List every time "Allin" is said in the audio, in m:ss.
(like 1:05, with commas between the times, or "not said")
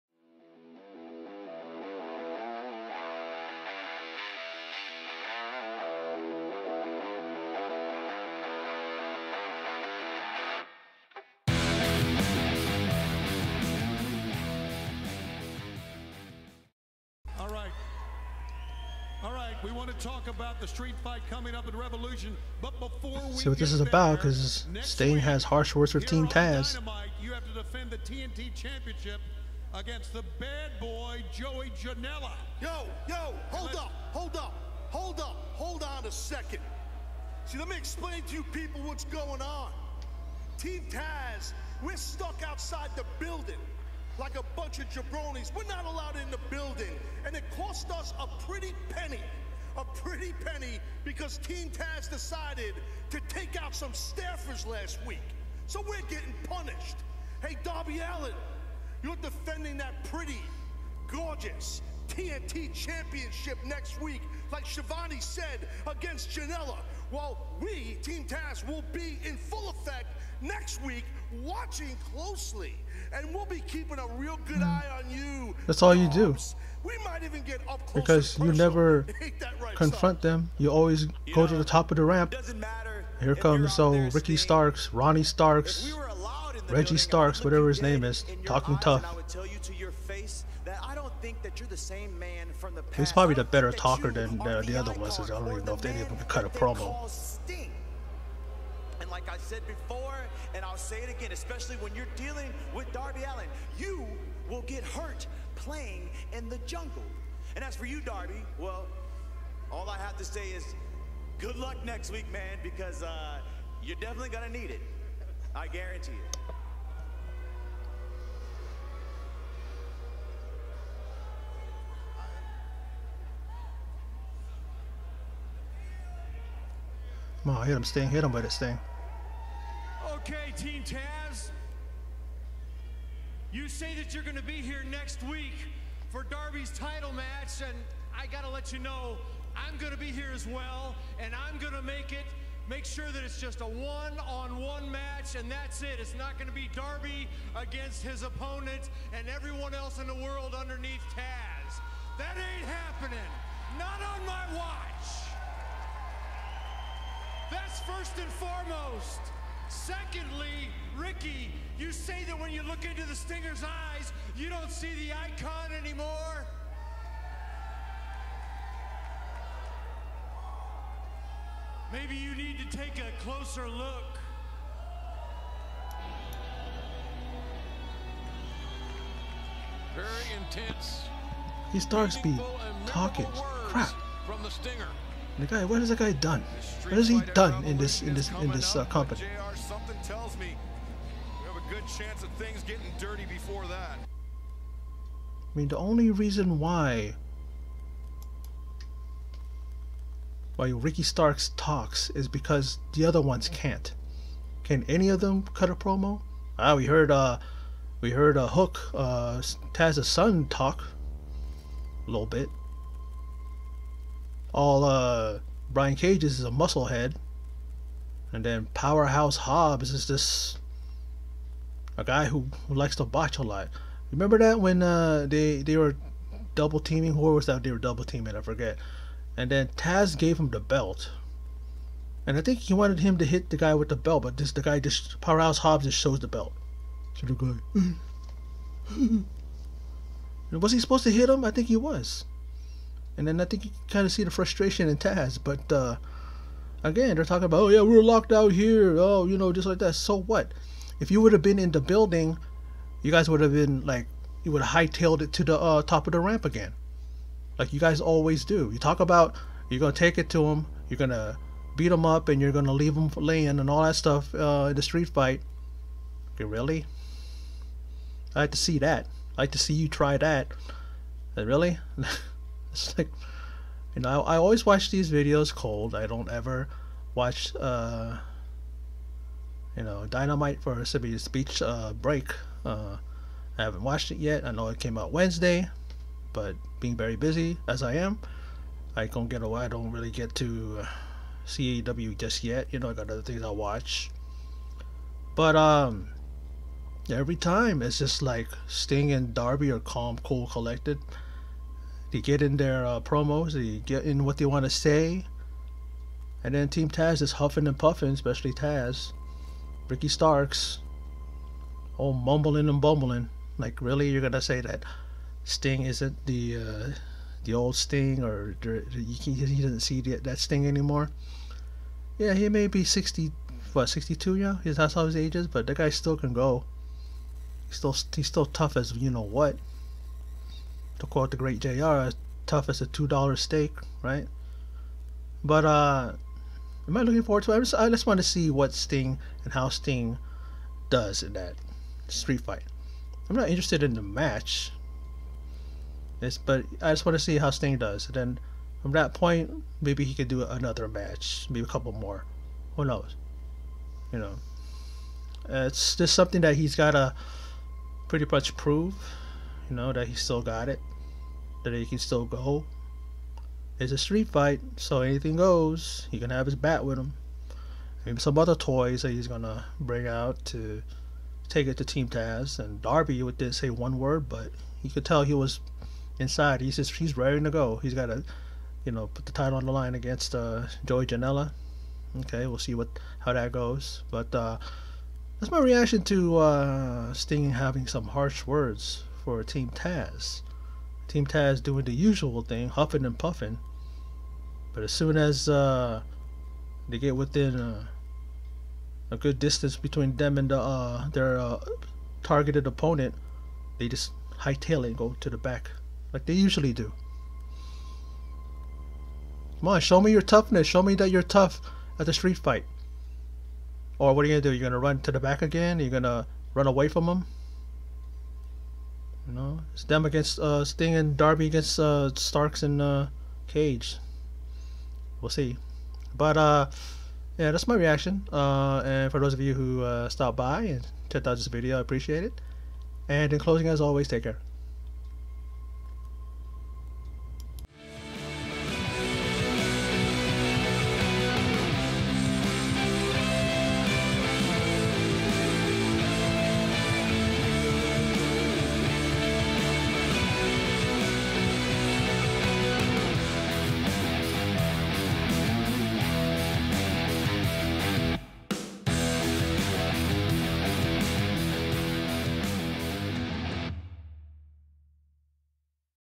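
0:57, 1:43.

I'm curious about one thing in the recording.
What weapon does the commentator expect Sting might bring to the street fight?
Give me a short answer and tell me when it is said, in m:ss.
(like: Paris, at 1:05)
His bat, at 6:06.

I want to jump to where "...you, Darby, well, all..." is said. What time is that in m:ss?
1:47.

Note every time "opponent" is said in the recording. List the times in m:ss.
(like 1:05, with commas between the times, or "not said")
2:28, 6:42.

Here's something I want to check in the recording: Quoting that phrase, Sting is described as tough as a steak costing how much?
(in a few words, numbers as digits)
$2.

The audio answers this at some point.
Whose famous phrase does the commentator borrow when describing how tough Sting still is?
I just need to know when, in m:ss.
5:31.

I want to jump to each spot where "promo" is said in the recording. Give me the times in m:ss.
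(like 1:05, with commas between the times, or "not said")
1:36, 3:25, 5:02.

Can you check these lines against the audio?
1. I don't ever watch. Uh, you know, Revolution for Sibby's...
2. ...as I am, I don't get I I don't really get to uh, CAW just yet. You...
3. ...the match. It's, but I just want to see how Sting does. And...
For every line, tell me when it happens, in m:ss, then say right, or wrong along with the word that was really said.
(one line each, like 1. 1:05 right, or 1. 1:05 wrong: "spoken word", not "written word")
1. 4:35 wrong: "Dynamite", not "Revolution"
2. 4:47 right
3. 5:43 right.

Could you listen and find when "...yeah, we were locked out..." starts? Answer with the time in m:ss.
4:07.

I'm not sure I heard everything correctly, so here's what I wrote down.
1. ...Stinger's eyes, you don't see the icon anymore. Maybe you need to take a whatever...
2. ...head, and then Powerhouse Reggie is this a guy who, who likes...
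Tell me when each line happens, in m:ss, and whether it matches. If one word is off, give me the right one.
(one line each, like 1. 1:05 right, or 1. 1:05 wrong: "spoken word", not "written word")
1. 2:43 wrong: "closer", not "whatever"
2. 3:36 wrong: "Hobbs", not "Reggie".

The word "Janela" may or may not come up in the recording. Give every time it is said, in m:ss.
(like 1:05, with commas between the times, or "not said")
0:31, 1:06, 6:21.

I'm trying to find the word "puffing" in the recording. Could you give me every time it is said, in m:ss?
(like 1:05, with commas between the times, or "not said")
5:07, 6:33.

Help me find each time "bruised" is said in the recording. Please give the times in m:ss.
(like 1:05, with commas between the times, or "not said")
not said.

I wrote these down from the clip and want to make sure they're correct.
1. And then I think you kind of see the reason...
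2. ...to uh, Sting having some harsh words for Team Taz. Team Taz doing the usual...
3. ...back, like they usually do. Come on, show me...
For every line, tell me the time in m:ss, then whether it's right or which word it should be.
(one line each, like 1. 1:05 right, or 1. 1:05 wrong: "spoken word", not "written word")
1. 4:03 wrong: "frustration", not "reason"
2. 6:26 right
3. 6:45 right.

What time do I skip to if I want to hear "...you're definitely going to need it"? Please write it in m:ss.
1:53.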